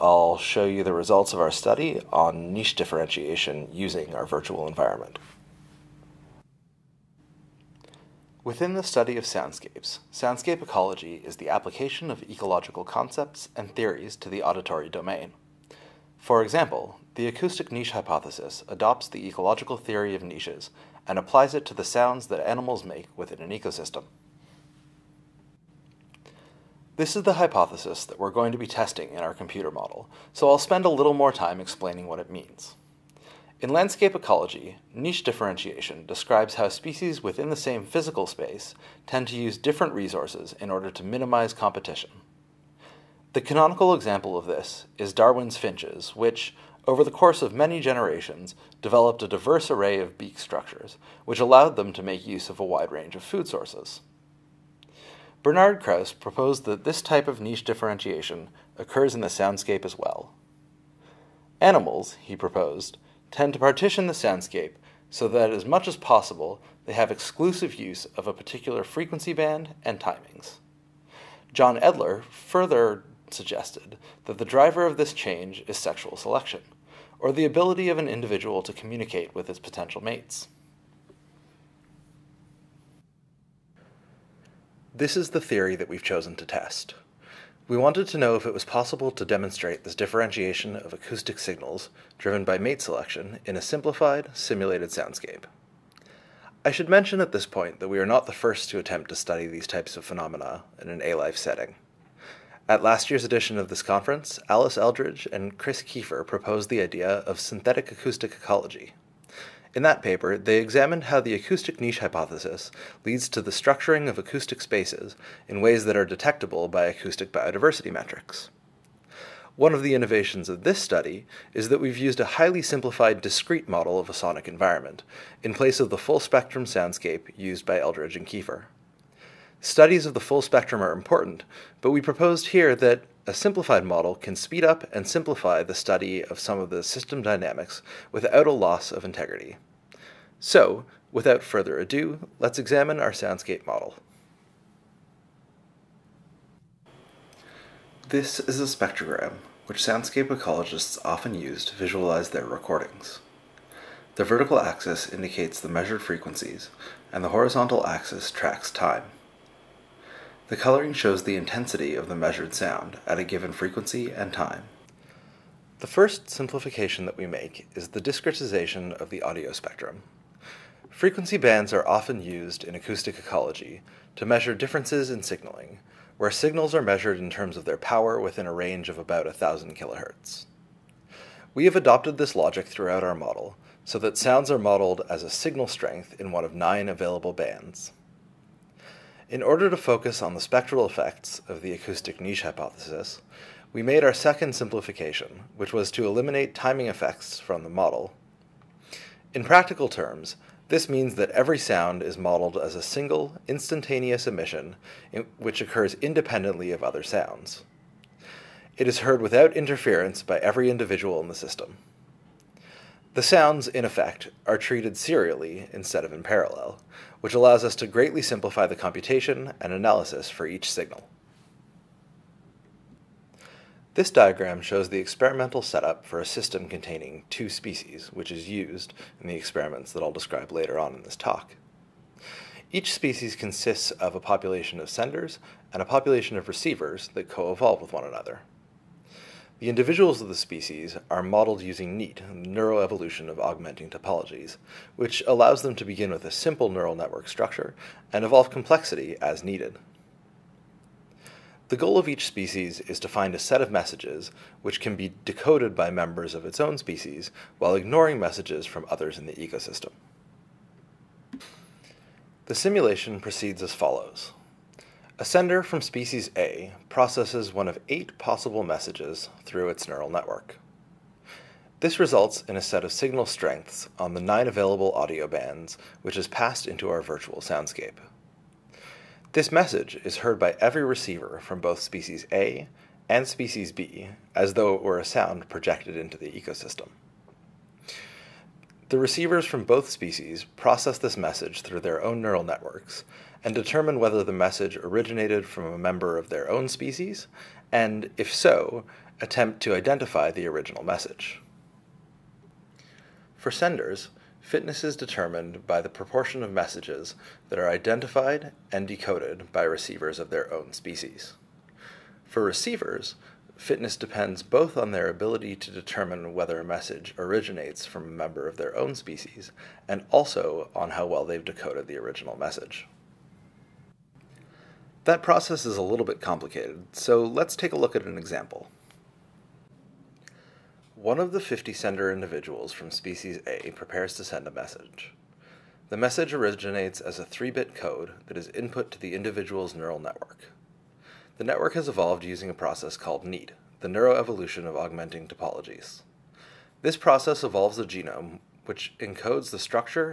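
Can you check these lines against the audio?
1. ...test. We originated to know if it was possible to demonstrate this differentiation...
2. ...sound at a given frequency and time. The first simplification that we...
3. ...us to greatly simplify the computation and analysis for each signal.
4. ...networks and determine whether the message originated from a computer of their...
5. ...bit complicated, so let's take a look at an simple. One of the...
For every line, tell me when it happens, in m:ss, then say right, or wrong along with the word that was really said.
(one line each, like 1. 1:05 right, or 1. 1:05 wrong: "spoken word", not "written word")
1. 1:26 wrong: "wanted", not "originated"
2. 2:42 right
3. 3:37 right
4. 4:52 wrong: "member", not "computer"
5. 5:26 wrong: "example", not "simple".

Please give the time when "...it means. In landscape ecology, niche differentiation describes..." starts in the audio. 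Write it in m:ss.
0:32.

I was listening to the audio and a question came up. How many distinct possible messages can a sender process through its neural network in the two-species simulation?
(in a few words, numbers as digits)
8.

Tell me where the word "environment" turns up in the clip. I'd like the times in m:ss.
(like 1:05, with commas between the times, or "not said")
0:04, 2:04.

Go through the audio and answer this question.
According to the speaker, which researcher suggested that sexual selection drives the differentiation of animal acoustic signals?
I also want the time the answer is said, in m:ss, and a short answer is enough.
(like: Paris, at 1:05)
John Endler, at 1:11.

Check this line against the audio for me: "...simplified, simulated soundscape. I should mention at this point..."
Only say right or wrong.
right.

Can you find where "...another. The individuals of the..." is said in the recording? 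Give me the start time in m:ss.
3:58.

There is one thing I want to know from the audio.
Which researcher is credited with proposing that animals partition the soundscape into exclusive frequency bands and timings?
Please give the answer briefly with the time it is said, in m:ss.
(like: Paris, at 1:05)
Bernard Krause, at 0:55.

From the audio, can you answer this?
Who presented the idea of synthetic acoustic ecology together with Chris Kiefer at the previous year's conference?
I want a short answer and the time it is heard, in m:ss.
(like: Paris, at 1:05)
Alice Eldridge, at 1:44.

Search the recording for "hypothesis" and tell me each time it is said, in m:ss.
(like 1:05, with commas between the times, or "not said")
0:17, 0:27, 1:51, 3:12.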